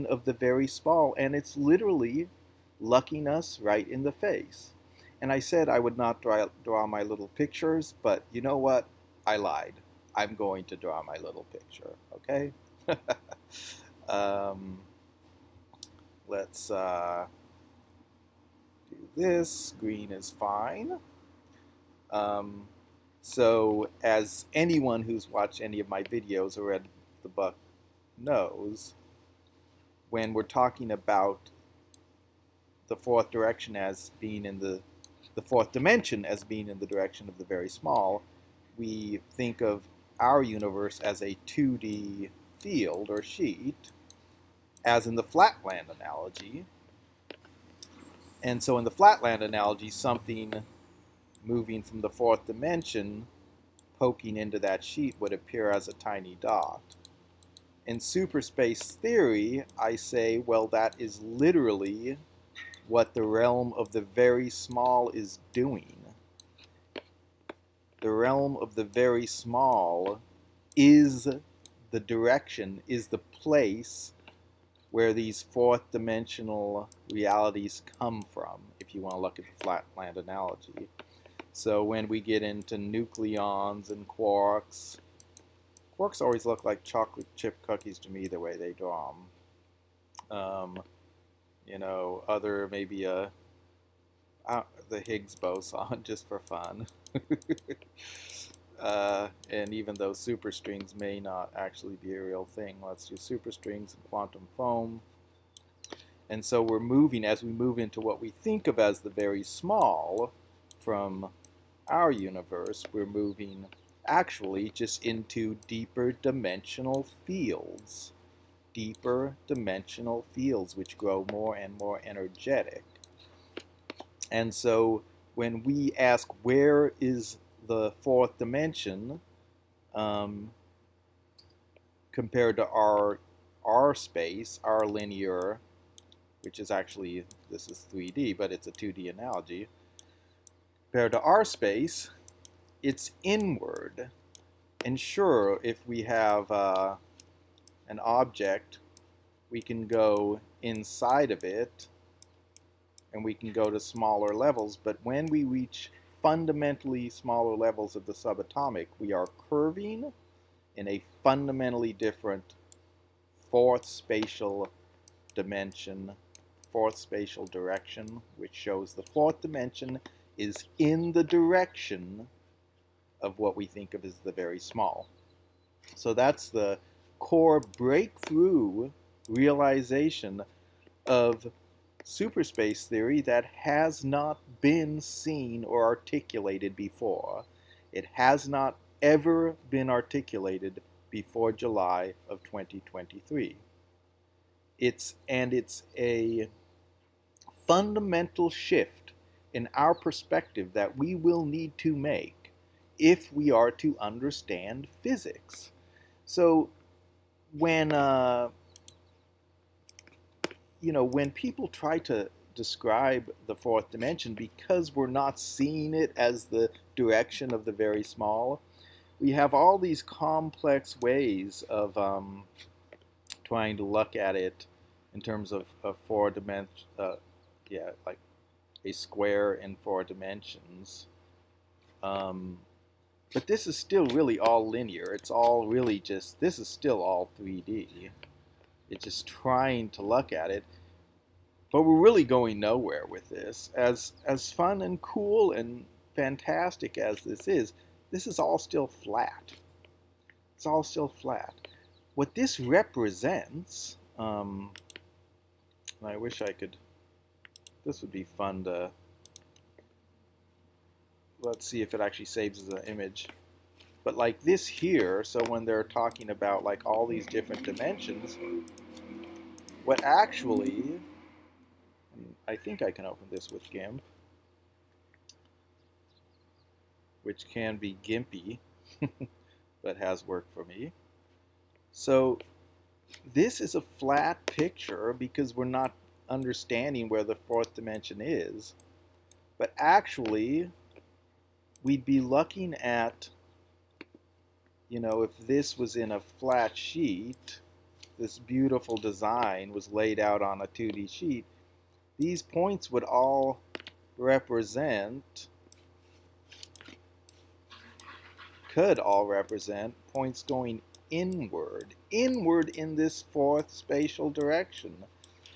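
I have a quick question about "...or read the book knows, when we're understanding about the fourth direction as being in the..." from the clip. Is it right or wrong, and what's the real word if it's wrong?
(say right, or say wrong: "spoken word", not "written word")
wrong: "talking", not "understanding".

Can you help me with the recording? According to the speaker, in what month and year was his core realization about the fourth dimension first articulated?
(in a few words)
July 2023.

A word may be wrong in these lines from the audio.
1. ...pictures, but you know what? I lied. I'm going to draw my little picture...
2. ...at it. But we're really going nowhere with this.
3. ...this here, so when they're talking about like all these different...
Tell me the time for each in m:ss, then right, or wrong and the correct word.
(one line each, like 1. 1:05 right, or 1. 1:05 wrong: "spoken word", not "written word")
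1. 0:07 right
2. 4:00 right
3. 4:24 right.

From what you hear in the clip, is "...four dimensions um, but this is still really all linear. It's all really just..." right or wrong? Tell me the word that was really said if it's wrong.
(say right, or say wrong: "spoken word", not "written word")
right.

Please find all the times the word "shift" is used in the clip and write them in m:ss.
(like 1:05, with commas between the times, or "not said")
3:18.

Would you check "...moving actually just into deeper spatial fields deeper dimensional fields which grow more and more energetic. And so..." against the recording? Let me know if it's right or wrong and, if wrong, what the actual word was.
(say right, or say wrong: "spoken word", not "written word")
wrong: "dimensional", not "spatial".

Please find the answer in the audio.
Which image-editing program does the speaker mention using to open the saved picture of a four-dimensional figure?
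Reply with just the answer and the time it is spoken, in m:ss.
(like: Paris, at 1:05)
GIMP, at 4:33.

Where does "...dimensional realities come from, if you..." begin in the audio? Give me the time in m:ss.
1:15.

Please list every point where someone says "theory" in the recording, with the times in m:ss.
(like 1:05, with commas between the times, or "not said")
0:58, 3:02.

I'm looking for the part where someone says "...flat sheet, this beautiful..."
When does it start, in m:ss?
4:56.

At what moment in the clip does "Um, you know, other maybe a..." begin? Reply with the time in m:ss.
1:30.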